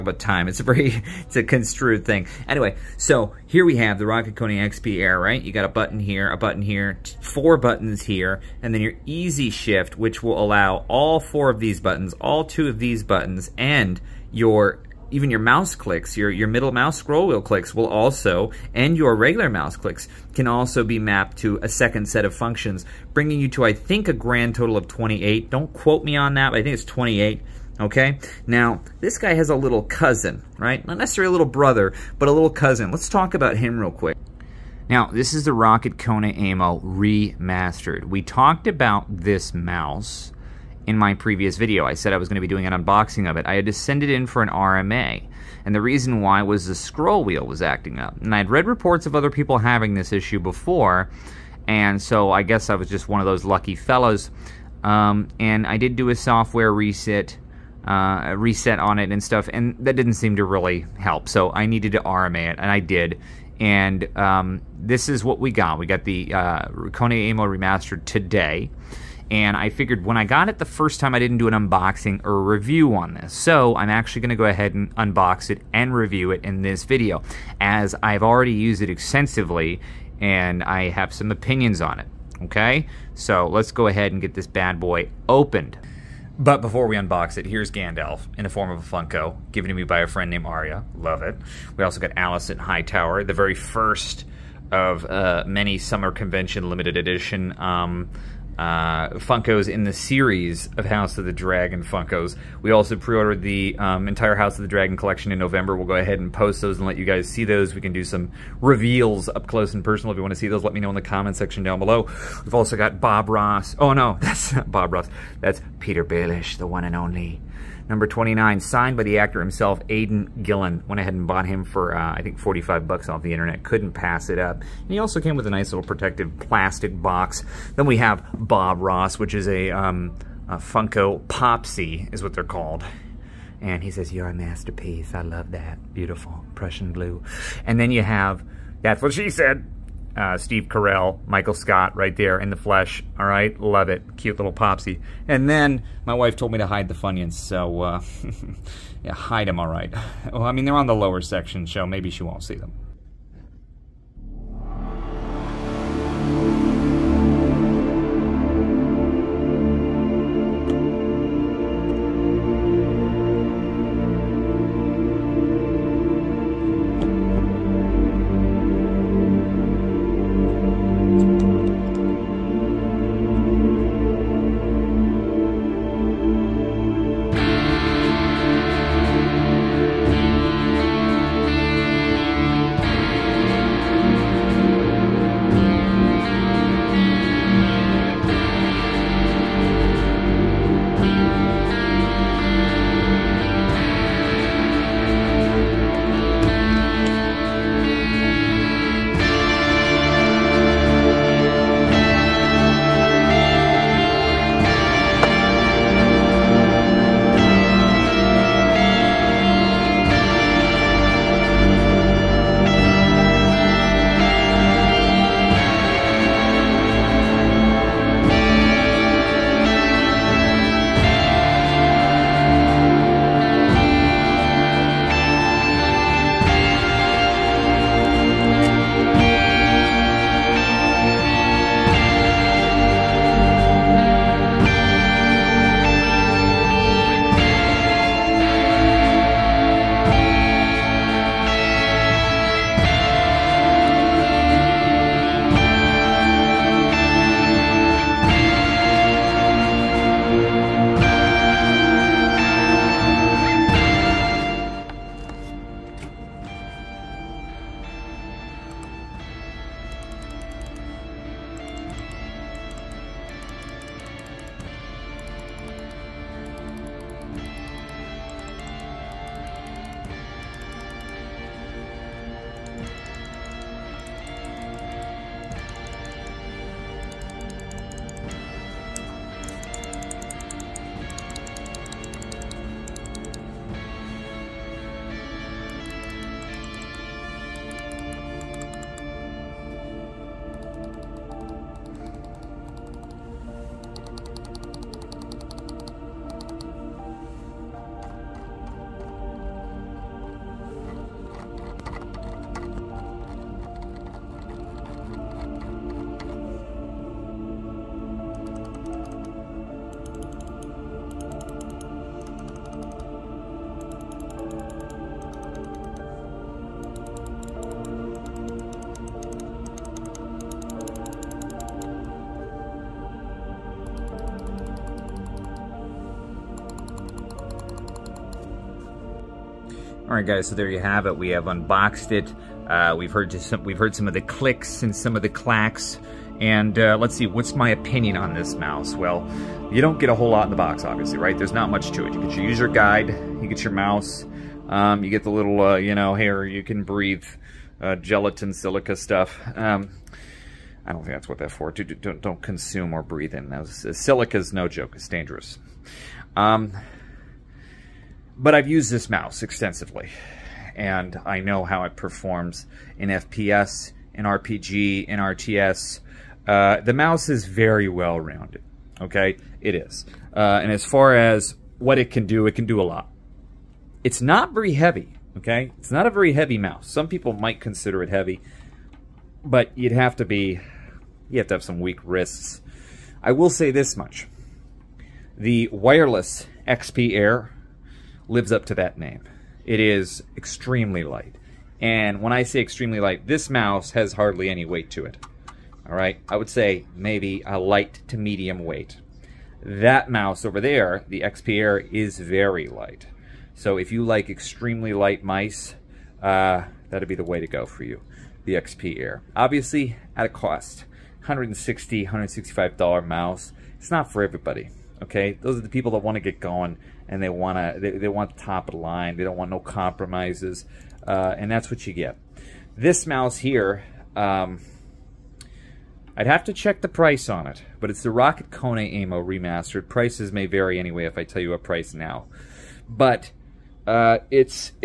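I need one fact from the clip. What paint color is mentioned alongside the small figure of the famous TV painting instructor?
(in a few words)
Prussian blue.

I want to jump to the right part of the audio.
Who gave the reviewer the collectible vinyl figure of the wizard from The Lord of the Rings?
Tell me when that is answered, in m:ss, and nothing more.
1:30.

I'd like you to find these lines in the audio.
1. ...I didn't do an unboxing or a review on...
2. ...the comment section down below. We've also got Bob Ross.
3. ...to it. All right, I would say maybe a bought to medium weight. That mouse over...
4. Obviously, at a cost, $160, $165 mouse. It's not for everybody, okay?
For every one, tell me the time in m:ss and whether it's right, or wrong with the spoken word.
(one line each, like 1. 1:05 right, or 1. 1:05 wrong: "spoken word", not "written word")
1. 1:11 right
2. 1:50 right
3. 6:34 wrong: "light", not "bought"
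4. 6:49 right.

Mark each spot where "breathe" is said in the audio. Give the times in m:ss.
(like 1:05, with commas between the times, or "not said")
5:46, 5:53.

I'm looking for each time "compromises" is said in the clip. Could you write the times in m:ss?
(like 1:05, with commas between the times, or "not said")
6:59.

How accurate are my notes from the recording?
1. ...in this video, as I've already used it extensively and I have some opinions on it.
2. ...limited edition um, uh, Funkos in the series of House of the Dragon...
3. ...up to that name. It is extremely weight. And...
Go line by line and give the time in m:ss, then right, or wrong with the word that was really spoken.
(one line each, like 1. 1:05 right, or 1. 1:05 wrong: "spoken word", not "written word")
1. 1:16 right
2. 1:36 right
3. 6:28 wrong: "light", not "weight".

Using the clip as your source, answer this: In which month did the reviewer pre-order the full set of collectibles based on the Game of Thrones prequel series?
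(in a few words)
November.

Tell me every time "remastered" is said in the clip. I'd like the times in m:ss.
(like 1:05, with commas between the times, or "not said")
0:36, 1:07, 7:09.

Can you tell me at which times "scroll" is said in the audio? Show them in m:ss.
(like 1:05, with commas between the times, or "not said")
0:16, 0:46.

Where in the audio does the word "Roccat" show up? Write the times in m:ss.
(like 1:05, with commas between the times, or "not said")
0:04, 0:35, 7:08.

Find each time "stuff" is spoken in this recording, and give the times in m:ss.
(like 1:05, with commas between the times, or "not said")
0:59, 5:48.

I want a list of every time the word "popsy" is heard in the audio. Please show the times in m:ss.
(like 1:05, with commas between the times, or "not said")
2:11, 2:24.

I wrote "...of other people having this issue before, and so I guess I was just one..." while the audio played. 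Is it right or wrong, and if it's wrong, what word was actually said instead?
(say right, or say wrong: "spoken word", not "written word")
right.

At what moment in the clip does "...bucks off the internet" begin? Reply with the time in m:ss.
2:02.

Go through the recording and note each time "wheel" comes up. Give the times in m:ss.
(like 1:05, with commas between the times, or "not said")
0:17, 0:47.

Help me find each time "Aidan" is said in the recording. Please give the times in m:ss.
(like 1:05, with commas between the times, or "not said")
1:59.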